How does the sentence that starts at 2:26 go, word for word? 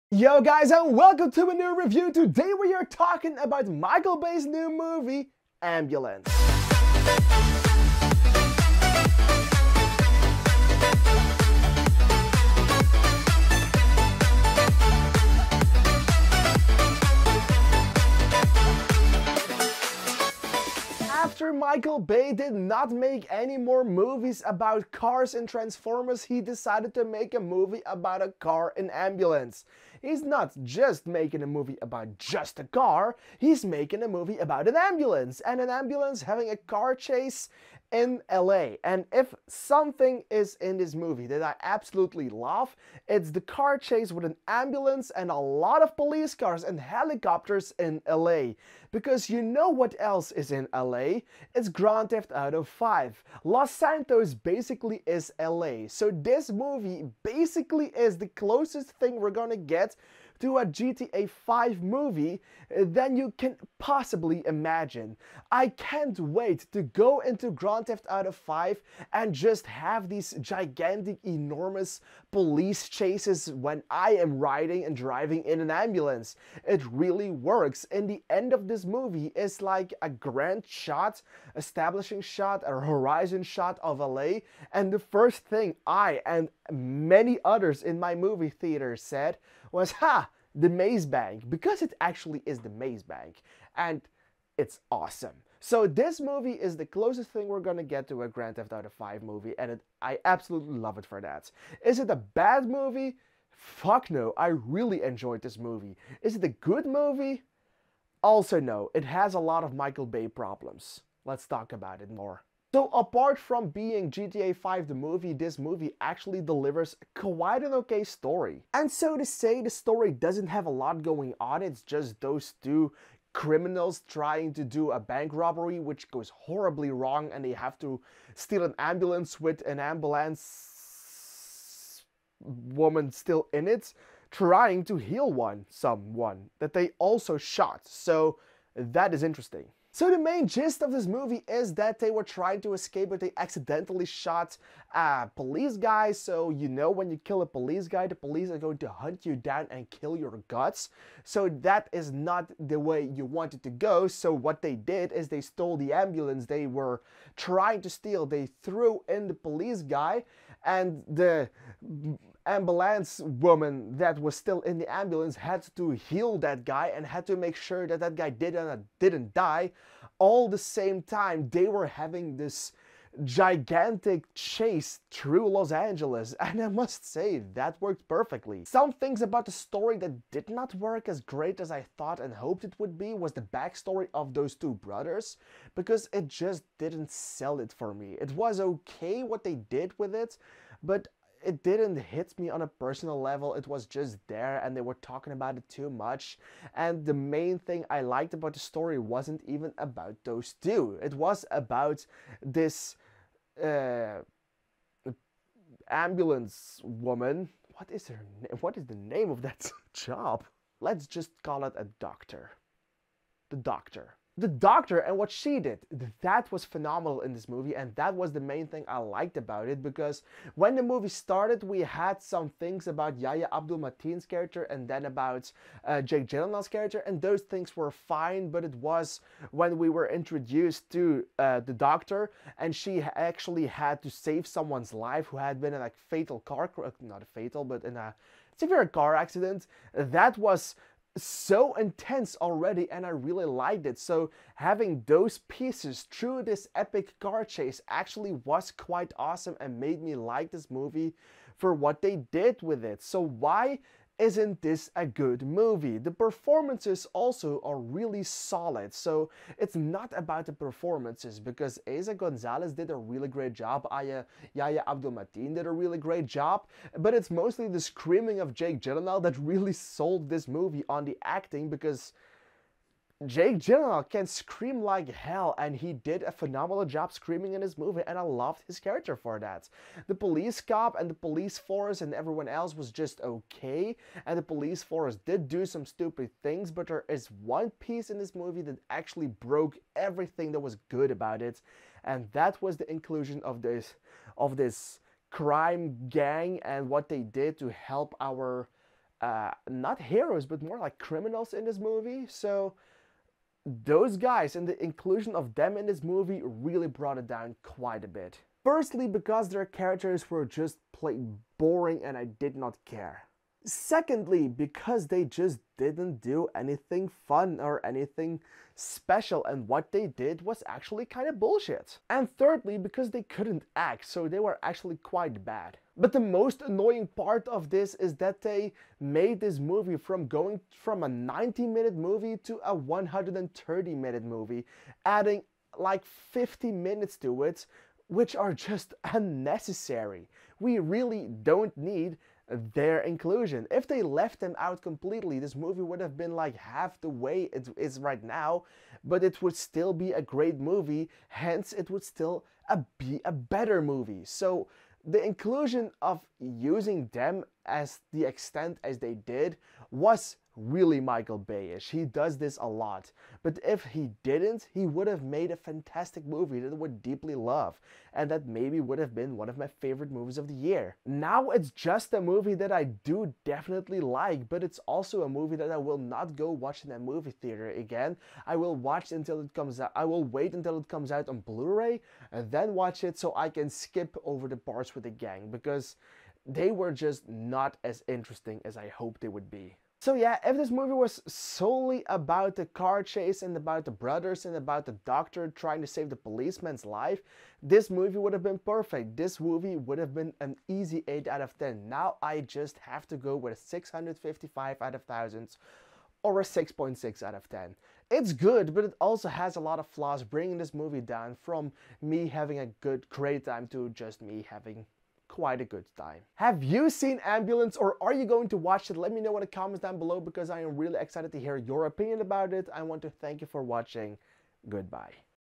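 So you know when you kill a police guy, the police are going to hunt you down and kill your guts.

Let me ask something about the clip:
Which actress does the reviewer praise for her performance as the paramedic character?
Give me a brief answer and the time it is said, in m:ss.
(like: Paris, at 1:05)
Eiza Gonzalez, at 4:21.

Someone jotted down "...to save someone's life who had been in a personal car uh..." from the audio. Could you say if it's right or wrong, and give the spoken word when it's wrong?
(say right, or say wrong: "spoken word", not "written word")
wrong: "fatal", not "personal".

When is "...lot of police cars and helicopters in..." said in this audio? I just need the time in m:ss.
0:45.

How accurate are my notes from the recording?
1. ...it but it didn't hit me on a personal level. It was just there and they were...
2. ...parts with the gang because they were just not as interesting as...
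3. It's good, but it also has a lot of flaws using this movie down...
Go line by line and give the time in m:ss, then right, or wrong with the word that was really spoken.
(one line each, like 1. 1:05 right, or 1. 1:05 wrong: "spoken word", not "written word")
1. 3:10 right
2. 6:24 right
3. 6:48 wrong: "bringing", not "using".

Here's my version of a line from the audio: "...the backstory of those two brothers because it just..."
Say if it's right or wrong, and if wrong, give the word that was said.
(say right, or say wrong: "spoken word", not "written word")
right.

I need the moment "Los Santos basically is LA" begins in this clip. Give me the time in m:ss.
0:53.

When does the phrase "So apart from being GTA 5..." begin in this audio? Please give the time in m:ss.
1:52.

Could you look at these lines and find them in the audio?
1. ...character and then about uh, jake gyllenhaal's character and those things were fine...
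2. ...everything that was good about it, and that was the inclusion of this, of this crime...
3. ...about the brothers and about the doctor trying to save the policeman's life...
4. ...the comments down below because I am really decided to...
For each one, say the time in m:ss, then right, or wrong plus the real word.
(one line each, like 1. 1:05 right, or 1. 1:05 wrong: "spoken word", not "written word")
1. 3:44 right
2. 4:49 right
3. 6:33 right
4. 6:59 wrong: "excited", not "decided".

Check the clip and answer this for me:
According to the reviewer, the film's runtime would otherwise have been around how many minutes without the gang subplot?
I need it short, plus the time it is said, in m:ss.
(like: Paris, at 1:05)
90, at 5:31.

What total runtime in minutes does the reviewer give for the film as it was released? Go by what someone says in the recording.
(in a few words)
130.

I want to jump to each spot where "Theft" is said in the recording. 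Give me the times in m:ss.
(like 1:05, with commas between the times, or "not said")
0:52, 1:07, 1:38.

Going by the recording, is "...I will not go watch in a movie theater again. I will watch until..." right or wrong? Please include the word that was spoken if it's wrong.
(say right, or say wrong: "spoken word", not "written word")
right.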